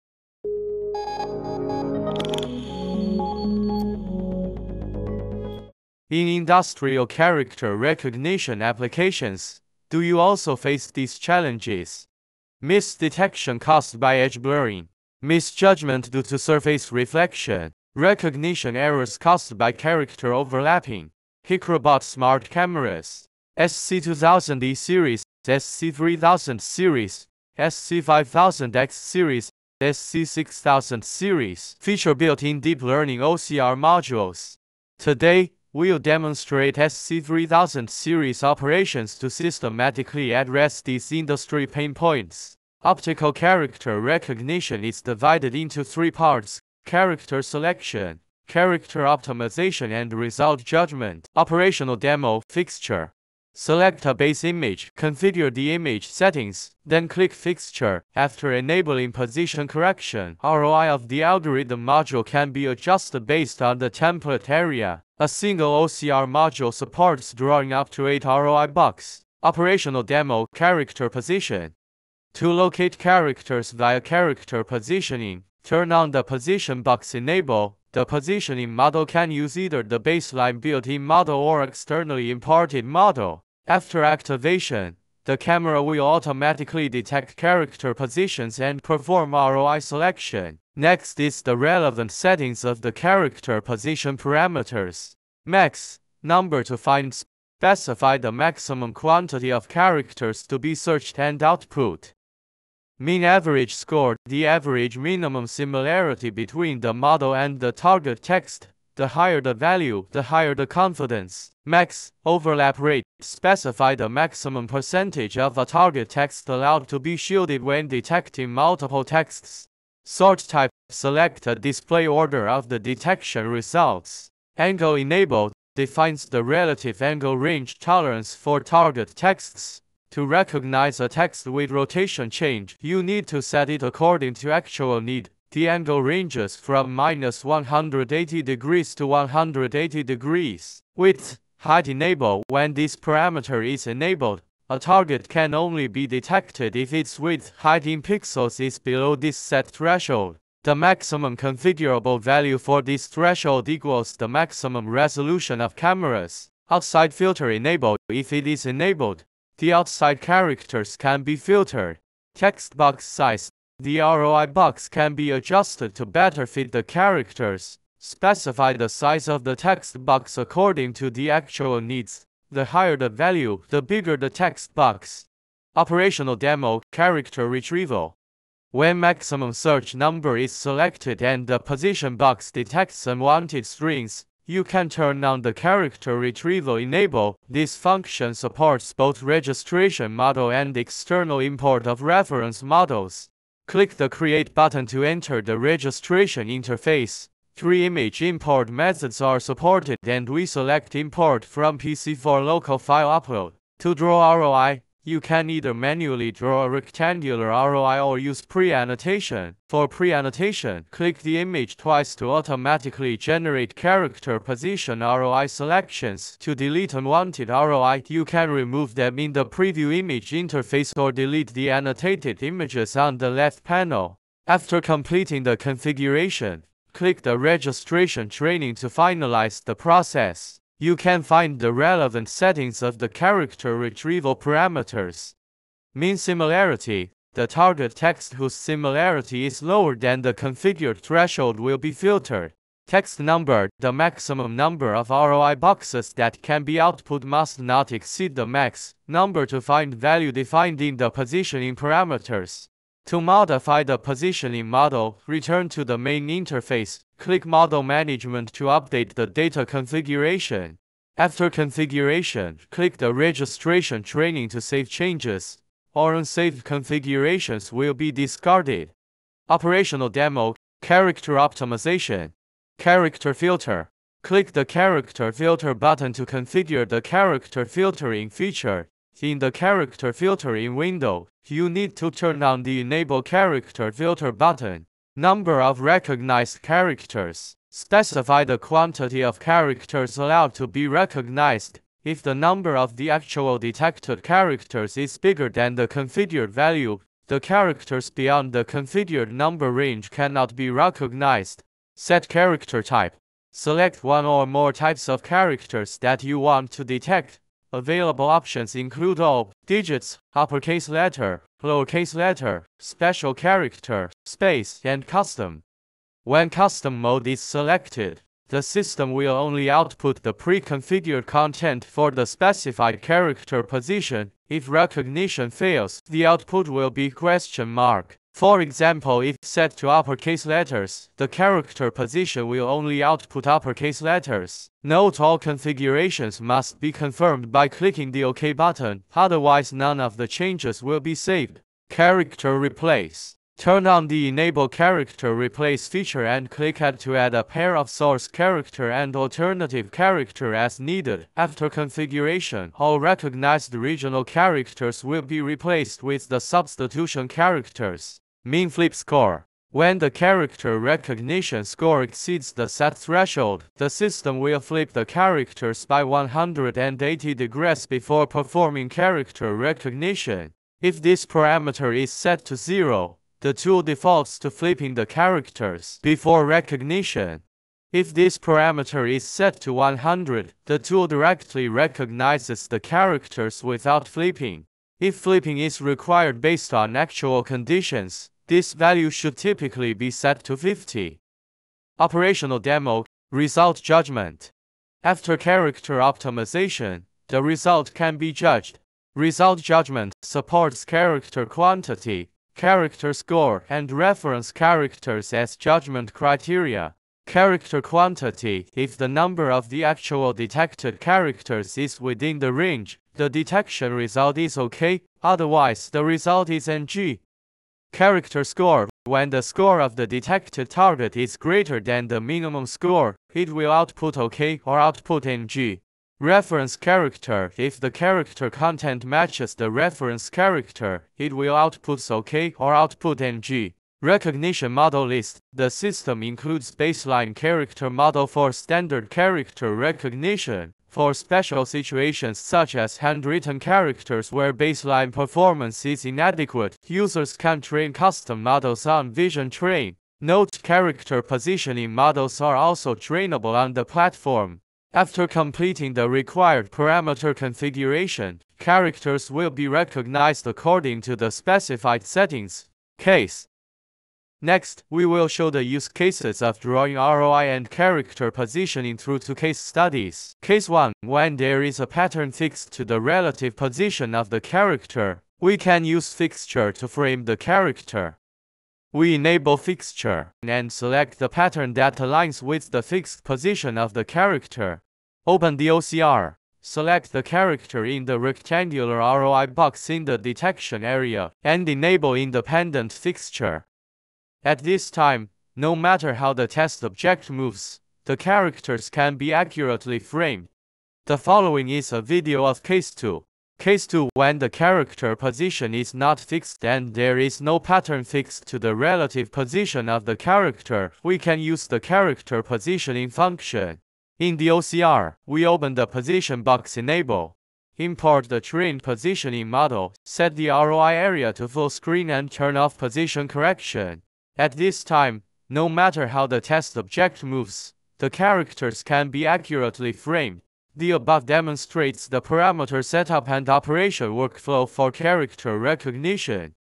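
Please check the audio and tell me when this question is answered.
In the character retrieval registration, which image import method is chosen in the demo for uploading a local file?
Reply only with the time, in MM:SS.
03:20.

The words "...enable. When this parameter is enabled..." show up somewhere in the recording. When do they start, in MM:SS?
02:21.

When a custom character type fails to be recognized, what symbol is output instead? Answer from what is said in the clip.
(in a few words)
question mark.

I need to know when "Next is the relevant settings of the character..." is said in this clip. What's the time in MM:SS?
01:30.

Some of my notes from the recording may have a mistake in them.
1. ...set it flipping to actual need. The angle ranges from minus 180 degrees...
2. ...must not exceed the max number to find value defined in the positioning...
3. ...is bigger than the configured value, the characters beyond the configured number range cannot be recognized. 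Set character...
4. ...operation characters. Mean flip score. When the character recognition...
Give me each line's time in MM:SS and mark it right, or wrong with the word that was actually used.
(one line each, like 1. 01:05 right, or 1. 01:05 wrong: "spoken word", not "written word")
1. 02:13 wrong: "according", not "flipping"
2. 04:07 right
3. 04:54 right
4. 05:56 wrong: "substitution", not "operation".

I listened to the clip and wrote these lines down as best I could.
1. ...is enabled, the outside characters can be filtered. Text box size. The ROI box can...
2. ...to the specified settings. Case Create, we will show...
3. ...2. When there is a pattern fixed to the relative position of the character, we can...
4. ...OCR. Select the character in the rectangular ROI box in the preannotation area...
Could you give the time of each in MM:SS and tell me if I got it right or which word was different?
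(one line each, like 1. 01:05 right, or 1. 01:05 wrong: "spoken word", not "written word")
1. 02:38 right
2. 07:41 wrong: "Next", not "Create"
3. 07:50 wrong: "1", not "2"
4. 08:05 wrong: "detection", not "preannotation".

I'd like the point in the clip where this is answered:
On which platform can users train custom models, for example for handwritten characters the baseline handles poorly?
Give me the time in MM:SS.
07:29.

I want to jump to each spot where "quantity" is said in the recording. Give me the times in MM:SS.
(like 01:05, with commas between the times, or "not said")
01:38, 04:48, 06:41, 06:47.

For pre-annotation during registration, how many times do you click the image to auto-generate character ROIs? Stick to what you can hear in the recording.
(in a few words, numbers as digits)
twice.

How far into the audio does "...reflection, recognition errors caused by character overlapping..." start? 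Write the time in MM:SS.
00:16.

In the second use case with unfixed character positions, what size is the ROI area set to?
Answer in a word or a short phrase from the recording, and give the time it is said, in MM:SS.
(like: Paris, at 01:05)
full screen, at 08:41.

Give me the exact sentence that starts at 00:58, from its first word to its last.
After enabling position correction, ROI of the algorithm module can be adjusted based on the template area.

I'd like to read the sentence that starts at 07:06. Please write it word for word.
Reference character If the character content matches the reference character, it will output OK or output NG.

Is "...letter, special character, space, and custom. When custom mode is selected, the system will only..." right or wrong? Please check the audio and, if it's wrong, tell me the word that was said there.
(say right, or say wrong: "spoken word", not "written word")
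right.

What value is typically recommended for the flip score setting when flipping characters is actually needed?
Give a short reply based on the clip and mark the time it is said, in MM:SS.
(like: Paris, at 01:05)
50, at 06:30.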